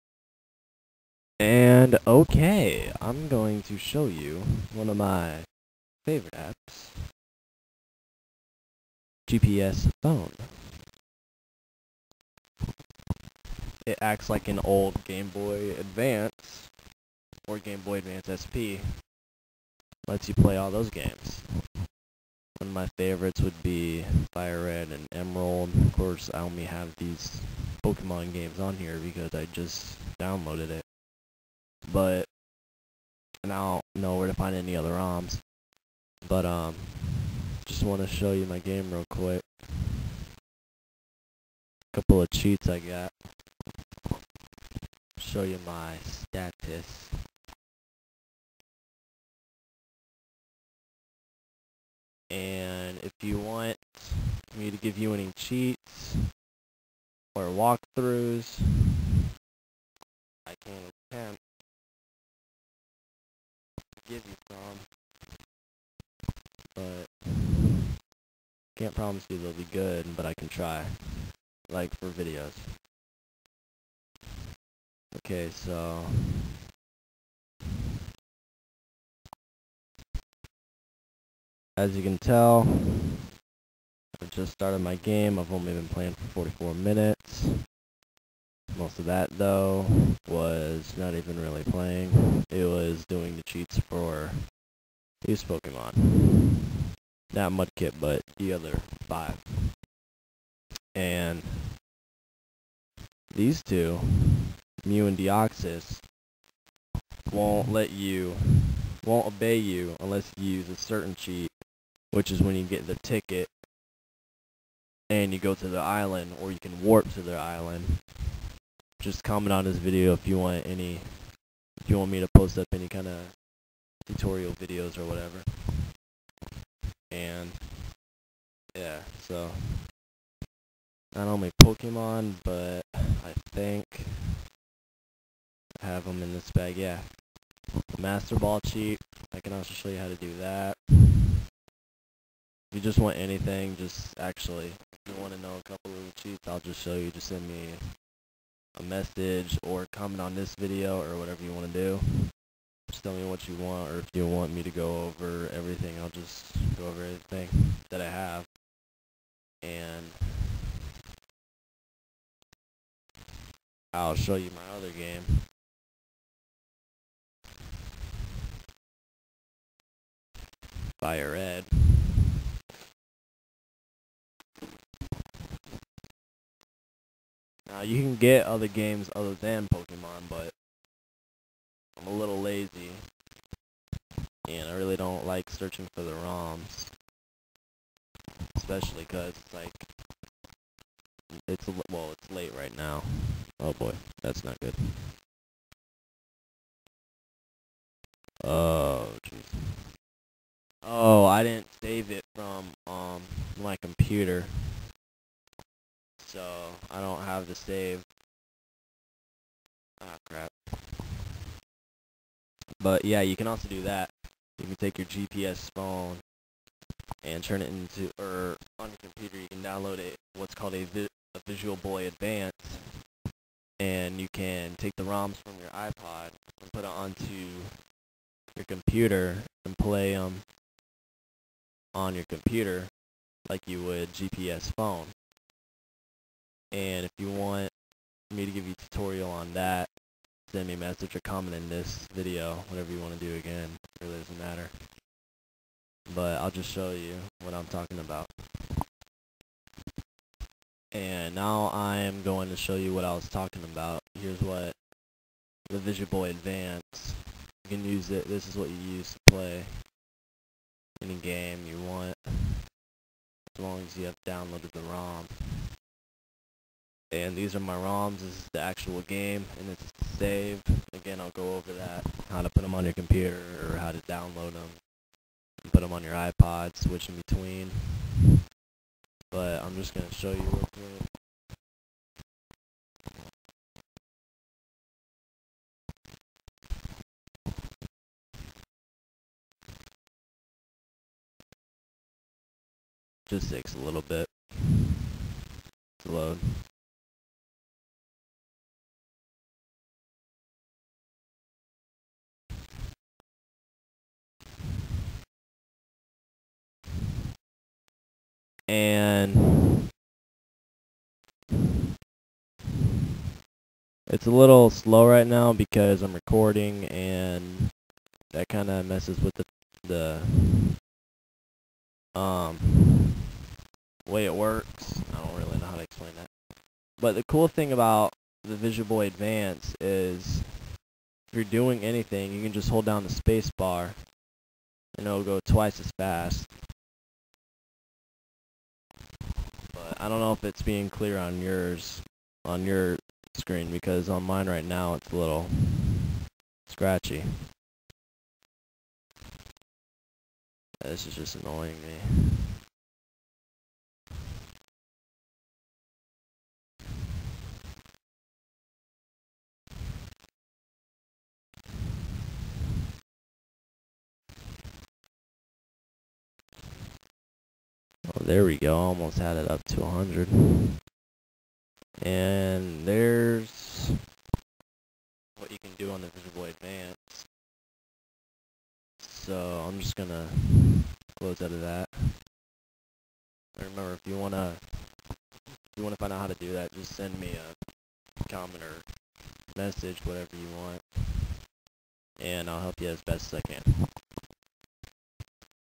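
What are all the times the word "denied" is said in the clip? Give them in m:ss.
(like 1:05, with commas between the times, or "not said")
not said.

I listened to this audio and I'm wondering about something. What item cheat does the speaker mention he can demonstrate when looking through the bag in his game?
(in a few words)
Master Ball.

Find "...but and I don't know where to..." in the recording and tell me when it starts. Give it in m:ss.
0:31.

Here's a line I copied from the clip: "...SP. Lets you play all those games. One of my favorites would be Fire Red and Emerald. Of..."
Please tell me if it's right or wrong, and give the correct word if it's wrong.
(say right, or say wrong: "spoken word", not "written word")
right.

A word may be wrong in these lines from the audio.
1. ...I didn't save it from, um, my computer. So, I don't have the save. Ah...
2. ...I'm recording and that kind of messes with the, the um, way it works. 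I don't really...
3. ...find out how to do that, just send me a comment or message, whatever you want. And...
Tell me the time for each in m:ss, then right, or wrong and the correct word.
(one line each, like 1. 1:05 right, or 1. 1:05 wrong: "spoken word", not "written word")
1. 3:21 right
2. 5:16 right
3. 6:26 right.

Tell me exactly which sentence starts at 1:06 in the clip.
But can't promise you they'll be good, but I can try.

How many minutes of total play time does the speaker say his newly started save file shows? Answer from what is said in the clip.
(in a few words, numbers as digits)
44.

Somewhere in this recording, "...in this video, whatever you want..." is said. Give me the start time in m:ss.
4:01.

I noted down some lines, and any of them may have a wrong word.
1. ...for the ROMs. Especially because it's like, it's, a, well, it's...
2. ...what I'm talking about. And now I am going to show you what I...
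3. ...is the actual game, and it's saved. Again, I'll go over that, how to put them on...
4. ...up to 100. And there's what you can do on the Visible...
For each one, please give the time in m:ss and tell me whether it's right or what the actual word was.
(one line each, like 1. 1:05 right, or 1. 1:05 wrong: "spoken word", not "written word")
1. 3:05 right
2. 4:07 right
3. 4:28 right
4. 6:09 right.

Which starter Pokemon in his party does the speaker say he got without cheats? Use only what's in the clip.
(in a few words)
Mudkip.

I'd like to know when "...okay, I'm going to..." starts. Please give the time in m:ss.
0:02.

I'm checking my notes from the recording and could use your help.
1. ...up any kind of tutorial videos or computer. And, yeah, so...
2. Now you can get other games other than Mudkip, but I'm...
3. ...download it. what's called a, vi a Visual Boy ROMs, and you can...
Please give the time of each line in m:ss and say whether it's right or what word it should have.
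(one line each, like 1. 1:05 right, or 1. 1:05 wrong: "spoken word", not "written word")
1. 2:02 wrong: "whatever", not "computer"
2. 2:57 wrong: "Pokemon", not "Mudkip"
3. 3:39 wrong: "Advance", not "ROMs".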